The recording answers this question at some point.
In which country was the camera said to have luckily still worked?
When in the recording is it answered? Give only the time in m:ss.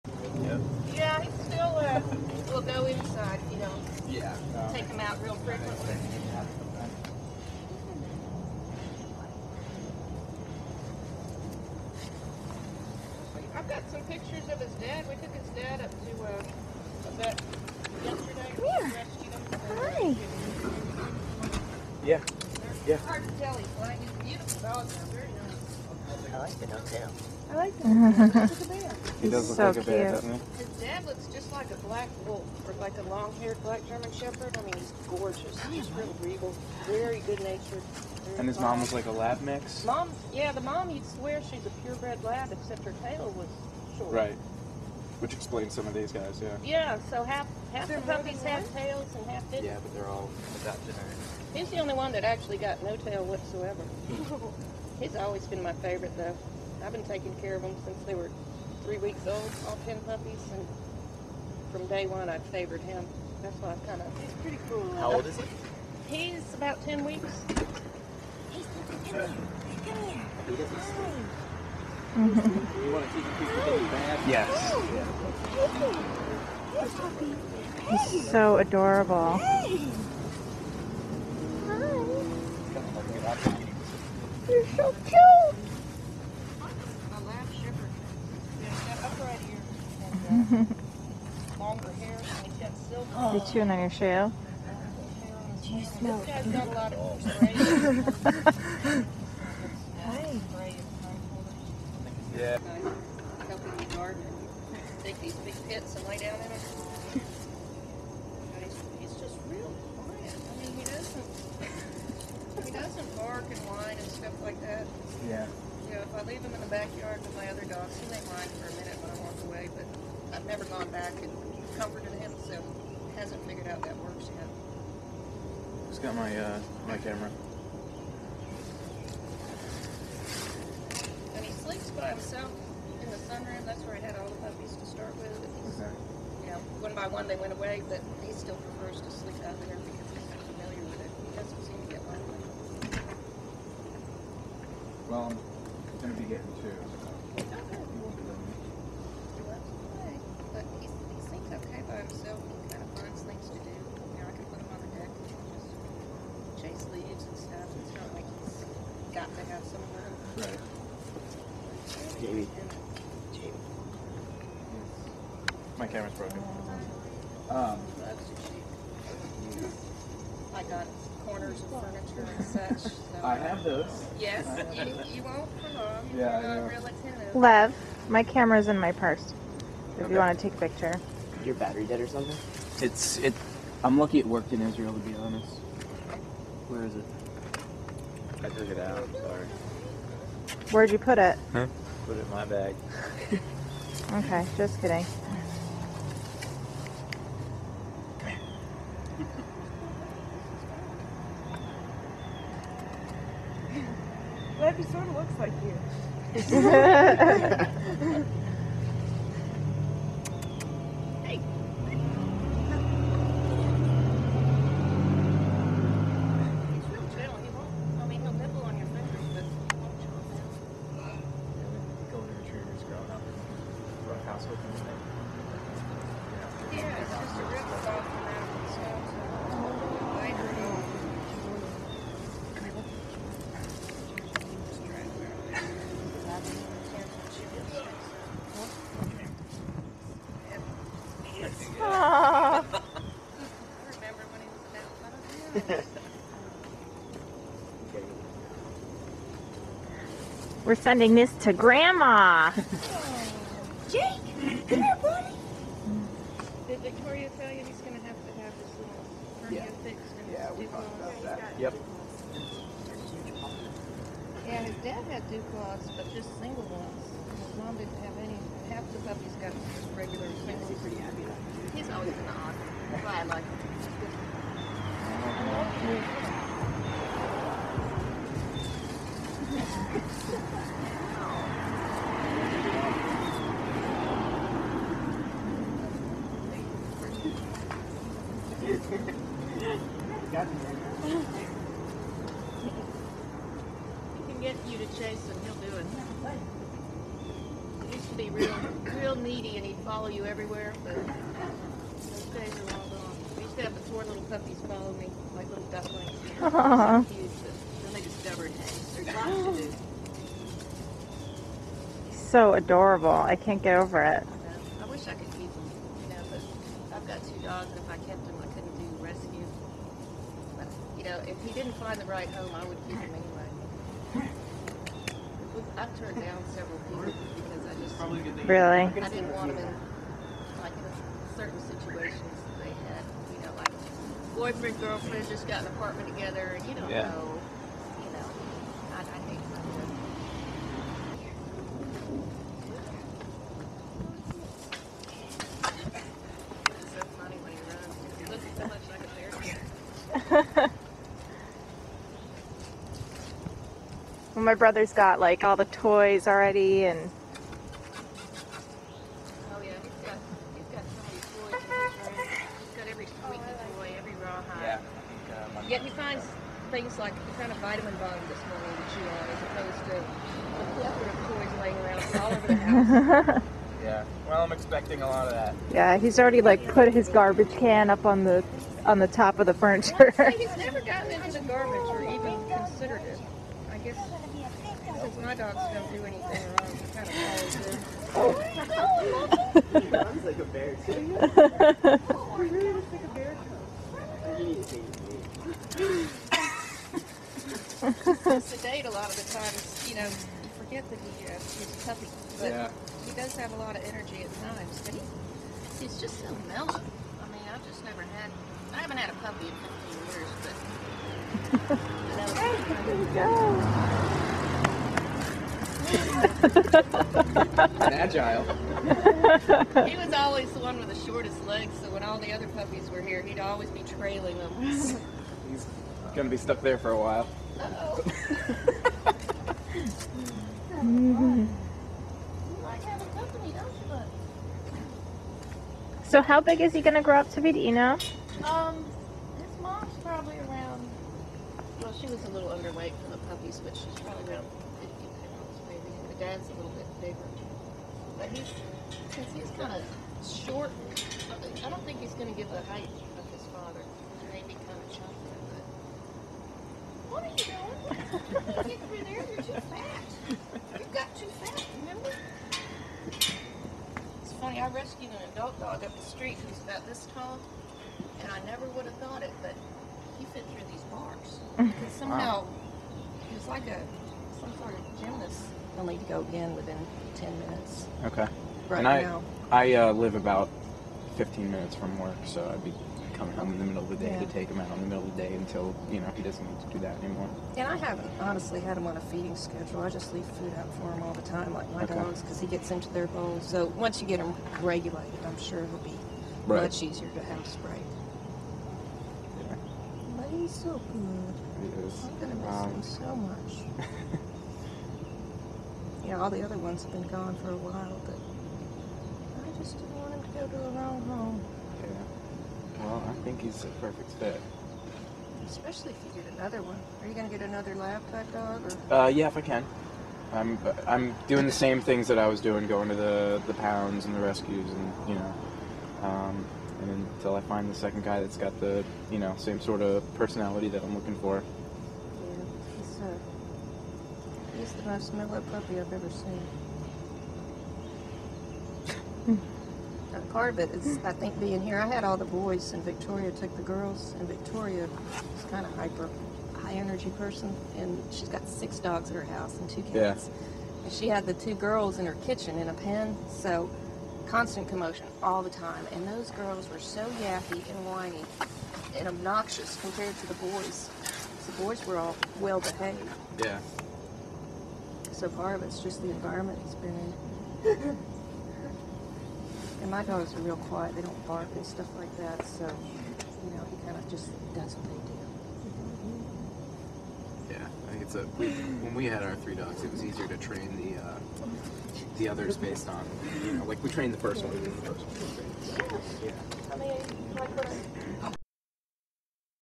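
3:04.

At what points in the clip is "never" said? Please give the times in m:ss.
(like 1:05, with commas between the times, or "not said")
2:00, 6:20, 6:47, 7:48.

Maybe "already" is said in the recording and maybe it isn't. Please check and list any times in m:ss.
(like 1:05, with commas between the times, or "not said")
5:56, 6:16.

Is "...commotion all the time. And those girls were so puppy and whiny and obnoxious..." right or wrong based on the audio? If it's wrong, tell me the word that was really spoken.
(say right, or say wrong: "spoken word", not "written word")
wrong: "yappy", not "puppy".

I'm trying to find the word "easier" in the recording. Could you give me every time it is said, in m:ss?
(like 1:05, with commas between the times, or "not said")
8:16, 9:40.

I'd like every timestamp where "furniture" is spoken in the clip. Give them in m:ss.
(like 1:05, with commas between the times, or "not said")
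2:51, 6:19.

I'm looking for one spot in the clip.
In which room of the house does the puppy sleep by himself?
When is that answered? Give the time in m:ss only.
2:13.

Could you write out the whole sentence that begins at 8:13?
So once you get him regulated, I'm sure it'll be right.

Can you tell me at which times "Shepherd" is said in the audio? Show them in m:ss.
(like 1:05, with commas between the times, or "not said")
0:34.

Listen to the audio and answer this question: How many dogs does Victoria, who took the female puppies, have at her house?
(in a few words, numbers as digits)
6.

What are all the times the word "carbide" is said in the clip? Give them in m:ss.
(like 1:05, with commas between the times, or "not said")
not said.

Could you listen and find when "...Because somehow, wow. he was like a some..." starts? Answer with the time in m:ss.
7:51.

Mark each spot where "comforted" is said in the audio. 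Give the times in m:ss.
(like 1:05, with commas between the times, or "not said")
2:01.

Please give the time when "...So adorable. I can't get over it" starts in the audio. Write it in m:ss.
5:12.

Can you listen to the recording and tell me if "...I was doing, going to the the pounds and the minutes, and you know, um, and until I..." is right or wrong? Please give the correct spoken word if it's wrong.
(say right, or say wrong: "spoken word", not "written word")
wrong: "rescues", not "minutes".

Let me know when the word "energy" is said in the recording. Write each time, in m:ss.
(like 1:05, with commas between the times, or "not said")
6:43, 9:06.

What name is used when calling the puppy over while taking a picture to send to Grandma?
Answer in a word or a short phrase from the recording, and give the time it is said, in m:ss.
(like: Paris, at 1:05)
Jake, at 4:13.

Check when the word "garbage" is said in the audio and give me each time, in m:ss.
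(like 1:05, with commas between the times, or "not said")
6:17, 6:21.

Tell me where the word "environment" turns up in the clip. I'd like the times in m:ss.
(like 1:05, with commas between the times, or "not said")
9:26.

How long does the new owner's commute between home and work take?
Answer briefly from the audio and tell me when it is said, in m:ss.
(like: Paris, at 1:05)
15 minutes, at 8:01.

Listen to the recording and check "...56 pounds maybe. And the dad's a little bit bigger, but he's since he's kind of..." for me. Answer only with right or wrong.
wrong.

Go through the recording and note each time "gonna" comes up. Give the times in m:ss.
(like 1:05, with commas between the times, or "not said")
7:06, 8:22.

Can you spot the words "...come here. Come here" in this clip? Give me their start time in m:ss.
1:08.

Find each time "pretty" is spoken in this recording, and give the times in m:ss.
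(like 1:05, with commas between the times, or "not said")
1:04, 4:30.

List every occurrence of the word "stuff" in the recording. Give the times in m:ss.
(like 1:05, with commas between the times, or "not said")
1:54, 9:31.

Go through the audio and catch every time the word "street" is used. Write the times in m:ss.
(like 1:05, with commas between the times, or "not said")
7:46.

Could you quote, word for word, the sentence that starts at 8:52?
Yeah, he's, uh, he's the most mellow puppy I've ever seen.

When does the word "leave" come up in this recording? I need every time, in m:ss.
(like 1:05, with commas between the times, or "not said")
1:56, 8:10.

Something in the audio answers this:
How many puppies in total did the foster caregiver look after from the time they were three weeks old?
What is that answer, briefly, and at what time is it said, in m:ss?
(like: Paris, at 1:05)
10, at 0:59.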